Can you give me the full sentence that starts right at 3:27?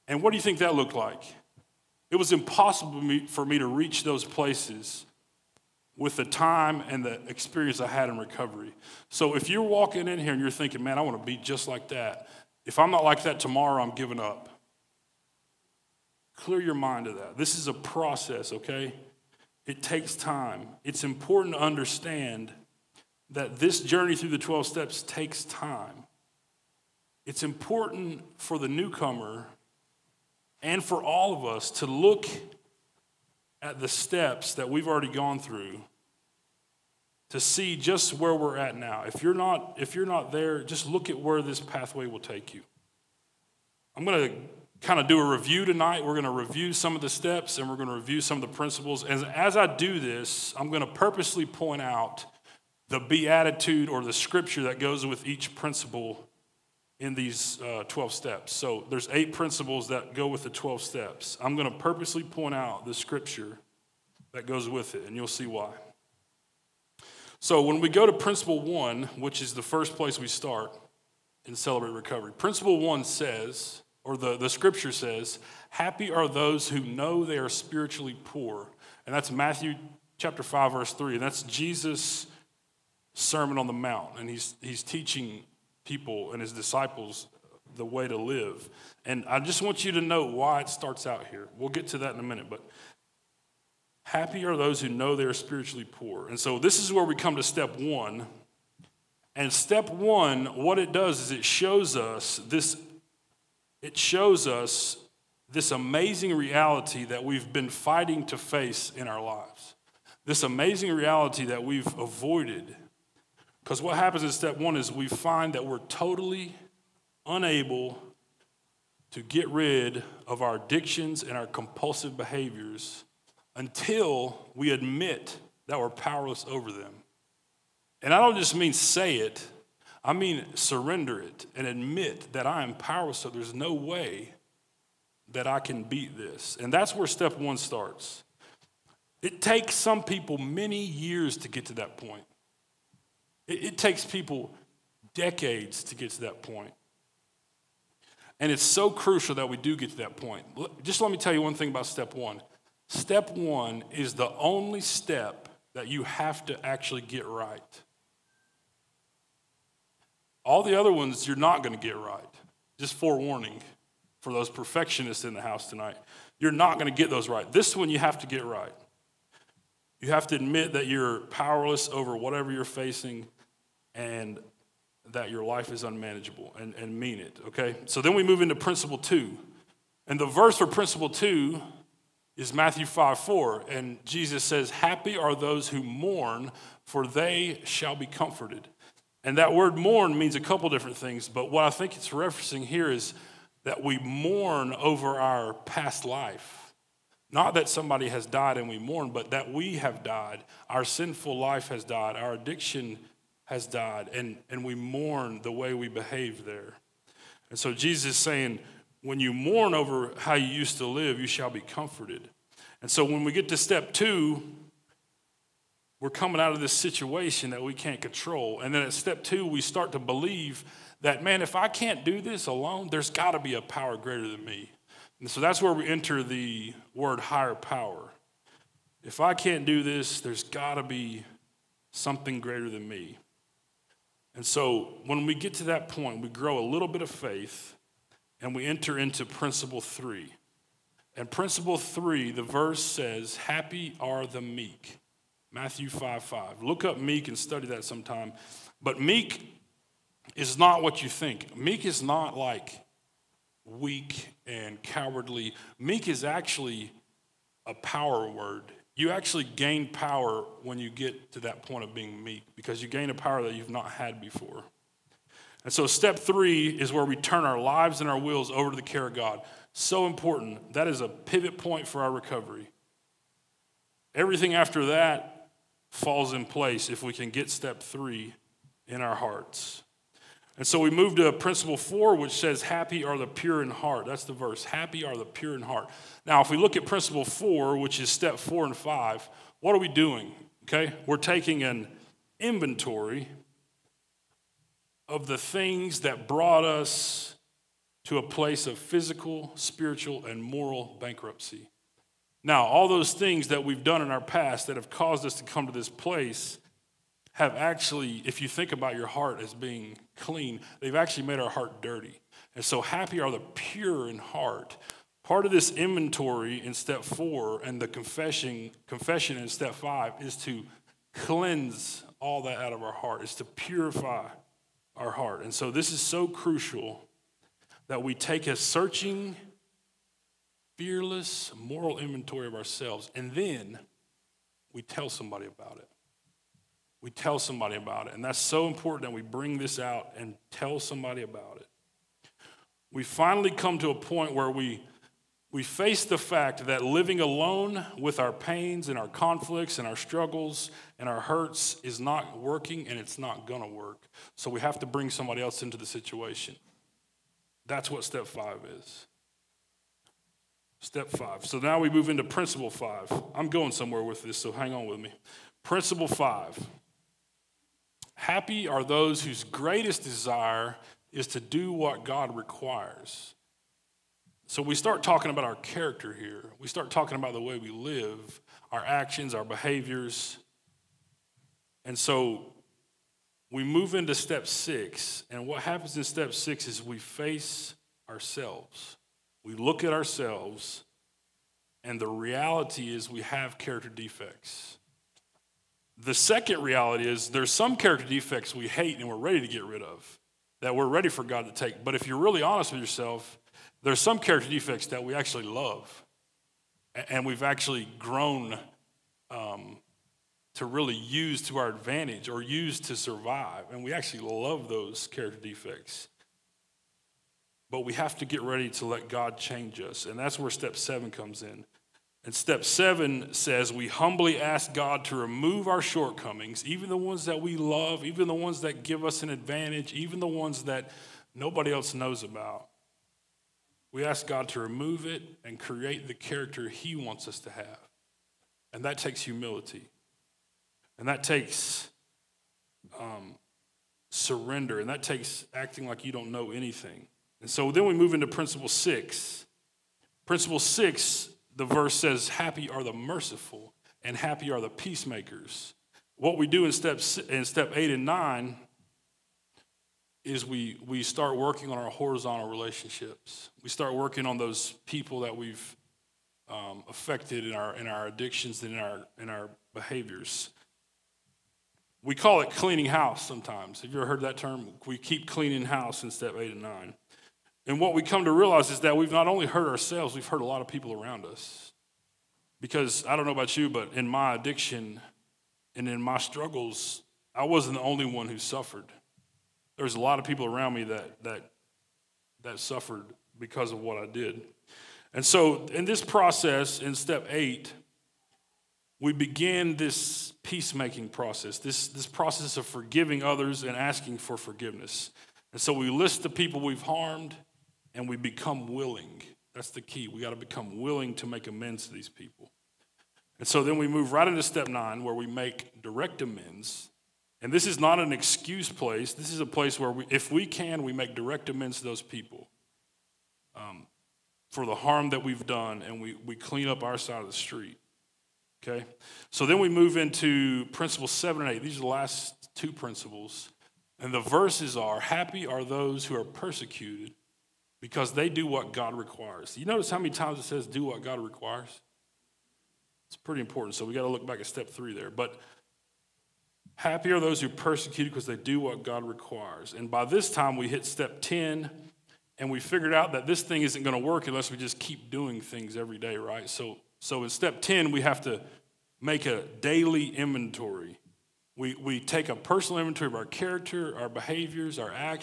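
And so Jesus is saying, when you mourn over how you used to live, you shall be comforted.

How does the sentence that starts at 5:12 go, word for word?
And so, happy are the pure in heart.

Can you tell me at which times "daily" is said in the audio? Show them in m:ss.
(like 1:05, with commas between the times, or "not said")
9:19.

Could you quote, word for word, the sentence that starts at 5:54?
So we have to bring somebody else into the situation.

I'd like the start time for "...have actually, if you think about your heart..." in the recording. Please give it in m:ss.
5:07.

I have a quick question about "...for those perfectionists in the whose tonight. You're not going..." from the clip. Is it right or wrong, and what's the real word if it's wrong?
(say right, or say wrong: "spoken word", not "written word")
wrong: "house", not "whose".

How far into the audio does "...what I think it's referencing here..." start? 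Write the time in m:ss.
3:11.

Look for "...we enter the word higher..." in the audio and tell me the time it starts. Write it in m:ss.
3:45.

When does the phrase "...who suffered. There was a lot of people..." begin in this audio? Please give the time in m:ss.
8:08.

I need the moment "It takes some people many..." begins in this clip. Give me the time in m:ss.
2:19.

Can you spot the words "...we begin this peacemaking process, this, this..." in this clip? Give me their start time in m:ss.
8:19.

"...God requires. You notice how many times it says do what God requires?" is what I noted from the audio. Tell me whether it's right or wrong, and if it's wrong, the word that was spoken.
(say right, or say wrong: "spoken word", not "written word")
right.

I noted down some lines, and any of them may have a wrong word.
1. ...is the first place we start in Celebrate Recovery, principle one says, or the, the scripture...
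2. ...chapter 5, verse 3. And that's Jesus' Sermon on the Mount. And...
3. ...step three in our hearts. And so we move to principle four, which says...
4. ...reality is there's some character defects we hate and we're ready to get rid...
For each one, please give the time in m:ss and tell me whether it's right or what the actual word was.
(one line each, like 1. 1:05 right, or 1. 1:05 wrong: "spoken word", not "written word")
1. 1:09 right
2. 1:20 right
3. 4:37 right
4. 6:36 right.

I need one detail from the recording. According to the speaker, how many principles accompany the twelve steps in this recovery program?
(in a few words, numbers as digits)
8.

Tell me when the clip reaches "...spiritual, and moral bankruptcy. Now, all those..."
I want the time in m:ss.
4:59.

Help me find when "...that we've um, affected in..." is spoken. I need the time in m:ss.
7:45.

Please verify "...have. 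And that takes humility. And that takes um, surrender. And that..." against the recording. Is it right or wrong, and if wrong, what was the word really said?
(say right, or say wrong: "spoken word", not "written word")
right.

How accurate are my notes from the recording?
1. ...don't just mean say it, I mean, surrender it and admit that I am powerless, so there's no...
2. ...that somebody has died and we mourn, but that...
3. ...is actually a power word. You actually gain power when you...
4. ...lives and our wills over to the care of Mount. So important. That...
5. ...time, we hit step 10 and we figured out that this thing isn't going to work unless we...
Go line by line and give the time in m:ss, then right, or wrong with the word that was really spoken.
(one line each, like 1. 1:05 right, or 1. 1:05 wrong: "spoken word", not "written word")
1. 2:08 right
2. 3:17 right
3. 4:16 right
4. 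4:27 wrong: "God", not "Mount"
5. 9:10 right.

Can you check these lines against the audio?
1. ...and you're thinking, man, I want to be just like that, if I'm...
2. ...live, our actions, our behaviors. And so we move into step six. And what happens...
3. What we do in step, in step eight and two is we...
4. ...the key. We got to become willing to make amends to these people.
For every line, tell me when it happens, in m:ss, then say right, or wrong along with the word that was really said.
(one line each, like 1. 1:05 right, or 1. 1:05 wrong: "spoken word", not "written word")
1. 0:10 right
2. 6:17 right
3. 7:36 wrong: "nine", not "two"
4. 8:29 right.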